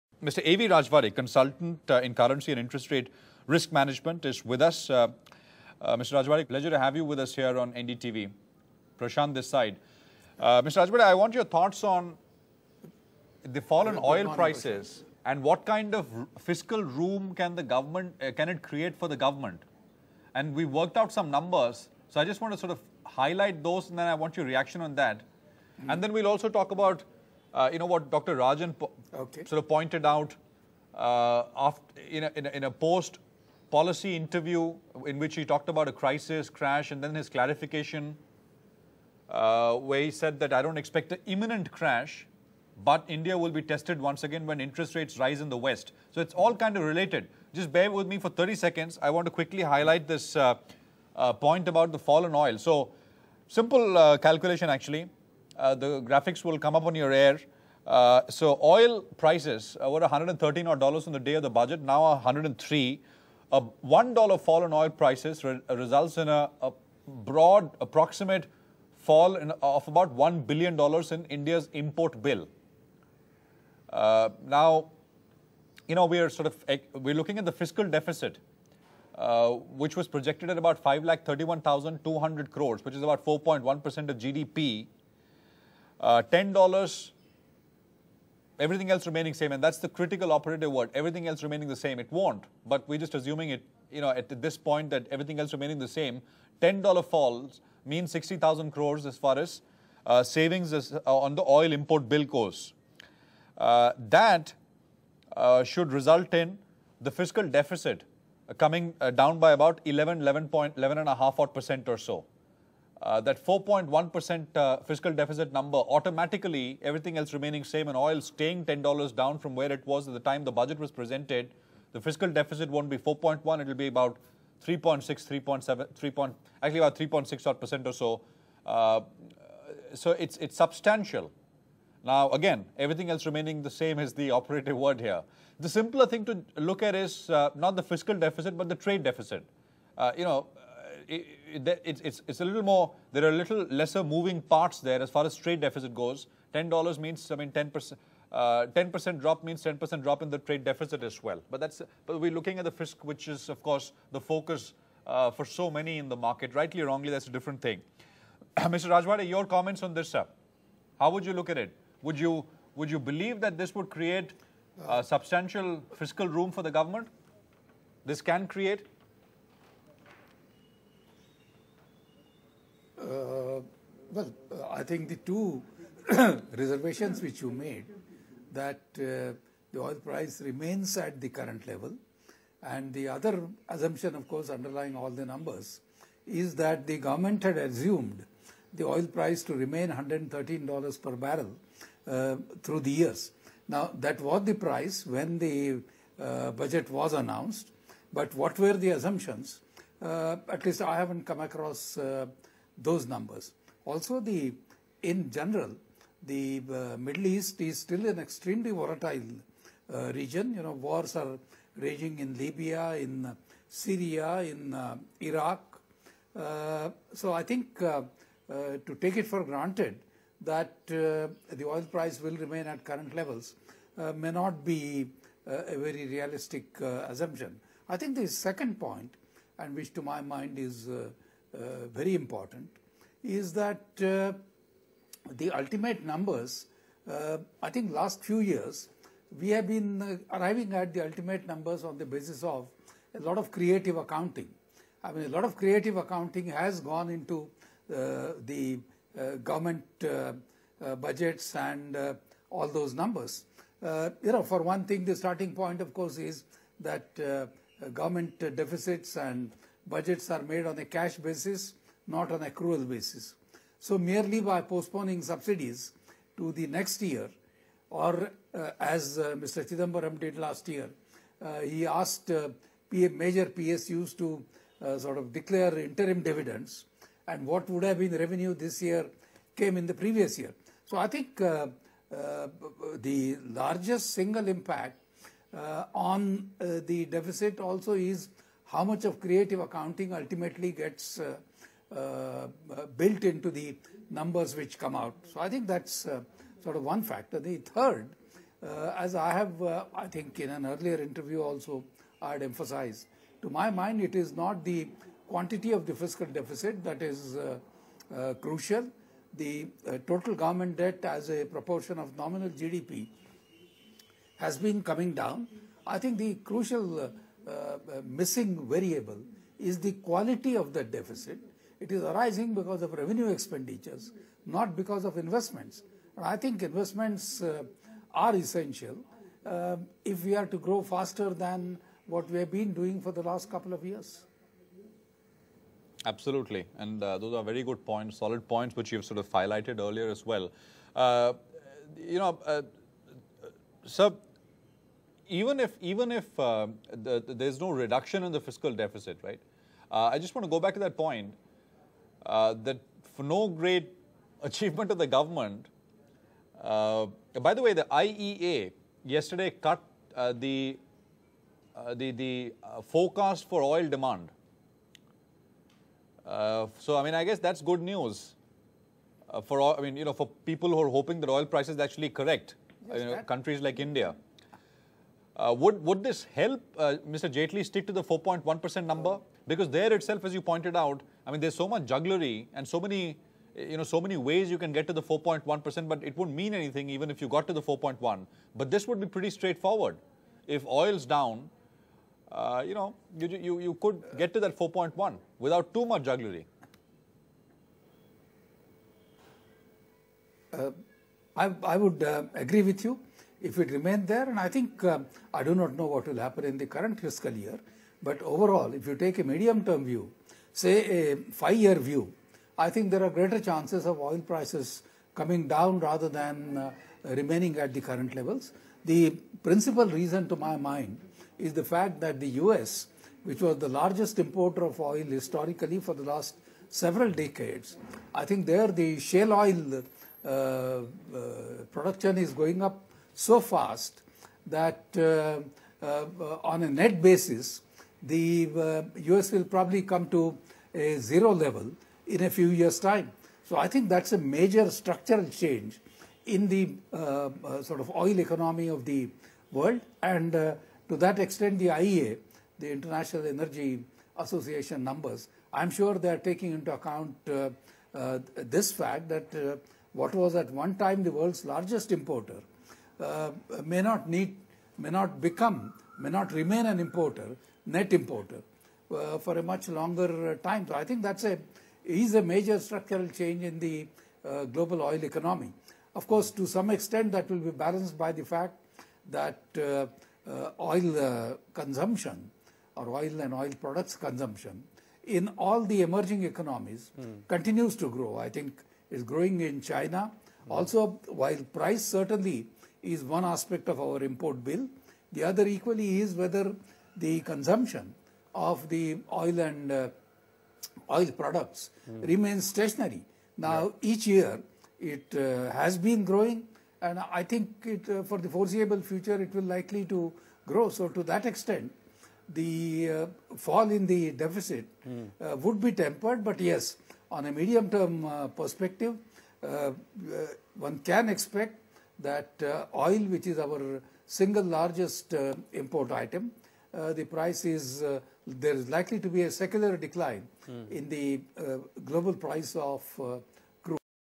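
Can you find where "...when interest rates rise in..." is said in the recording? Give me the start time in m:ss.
0:44.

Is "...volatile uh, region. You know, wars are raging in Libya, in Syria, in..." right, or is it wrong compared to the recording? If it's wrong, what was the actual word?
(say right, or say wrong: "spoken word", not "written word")
right.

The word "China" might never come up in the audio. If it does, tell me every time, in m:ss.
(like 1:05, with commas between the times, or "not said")
8:09.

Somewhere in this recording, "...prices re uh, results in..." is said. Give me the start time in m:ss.
1:04.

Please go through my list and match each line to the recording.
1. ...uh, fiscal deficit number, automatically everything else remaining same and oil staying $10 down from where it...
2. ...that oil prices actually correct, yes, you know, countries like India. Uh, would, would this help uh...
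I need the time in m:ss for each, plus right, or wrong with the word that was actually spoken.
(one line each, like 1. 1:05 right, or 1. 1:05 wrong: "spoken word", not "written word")
1. 1:54 right
2. 6:11 right.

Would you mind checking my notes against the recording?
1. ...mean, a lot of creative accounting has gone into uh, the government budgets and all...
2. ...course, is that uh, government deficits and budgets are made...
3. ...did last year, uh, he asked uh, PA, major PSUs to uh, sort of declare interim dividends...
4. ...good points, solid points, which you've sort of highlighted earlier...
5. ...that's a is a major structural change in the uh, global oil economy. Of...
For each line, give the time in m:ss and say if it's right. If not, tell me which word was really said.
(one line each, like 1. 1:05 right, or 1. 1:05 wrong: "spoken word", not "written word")
1. 4:05 right
2. 4:15 right
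3. 4:30 right
4. 5:37 right
5. 7:51 right.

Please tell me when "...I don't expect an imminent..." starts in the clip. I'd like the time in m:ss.
0:40.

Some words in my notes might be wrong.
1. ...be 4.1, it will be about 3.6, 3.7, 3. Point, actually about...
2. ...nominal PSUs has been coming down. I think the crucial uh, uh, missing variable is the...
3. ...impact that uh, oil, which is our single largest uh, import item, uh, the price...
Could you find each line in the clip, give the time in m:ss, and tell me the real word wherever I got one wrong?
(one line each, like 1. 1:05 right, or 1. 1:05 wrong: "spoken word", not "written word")
1. 2:02 right
2. 5:12 wrong: "GDP", not "PSUs"
3. 8:41 wrong: "expect", not "impact".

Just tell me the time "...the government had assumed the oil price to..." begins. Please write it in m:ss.
3:06.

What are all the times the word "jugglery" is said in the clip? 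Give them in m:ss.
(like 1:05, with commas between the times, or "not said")
6:21, 6:36.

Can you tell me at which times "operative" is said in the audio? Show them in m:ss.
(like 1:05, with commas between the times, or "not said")
1:30, 2:14.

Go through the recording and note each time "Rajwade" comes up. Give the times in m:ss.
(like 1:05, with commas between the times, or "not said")
0:00, 0:06, 0:10, 2:38.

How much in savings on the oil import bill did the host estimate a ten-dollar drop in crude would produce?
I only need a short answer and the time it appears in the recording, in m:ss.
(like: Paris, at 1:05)
60,000 crores, at 1:38.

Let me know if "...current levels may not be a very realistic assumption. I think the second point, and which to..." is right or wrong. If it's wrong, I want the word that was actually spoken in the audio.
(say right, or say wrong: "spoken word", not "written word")
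right.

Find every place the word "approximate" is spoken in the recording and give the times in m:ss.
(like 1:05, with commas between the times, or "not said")
1:07.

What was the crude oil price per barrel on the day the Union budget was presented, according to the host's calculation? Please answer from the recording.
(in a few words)
$113.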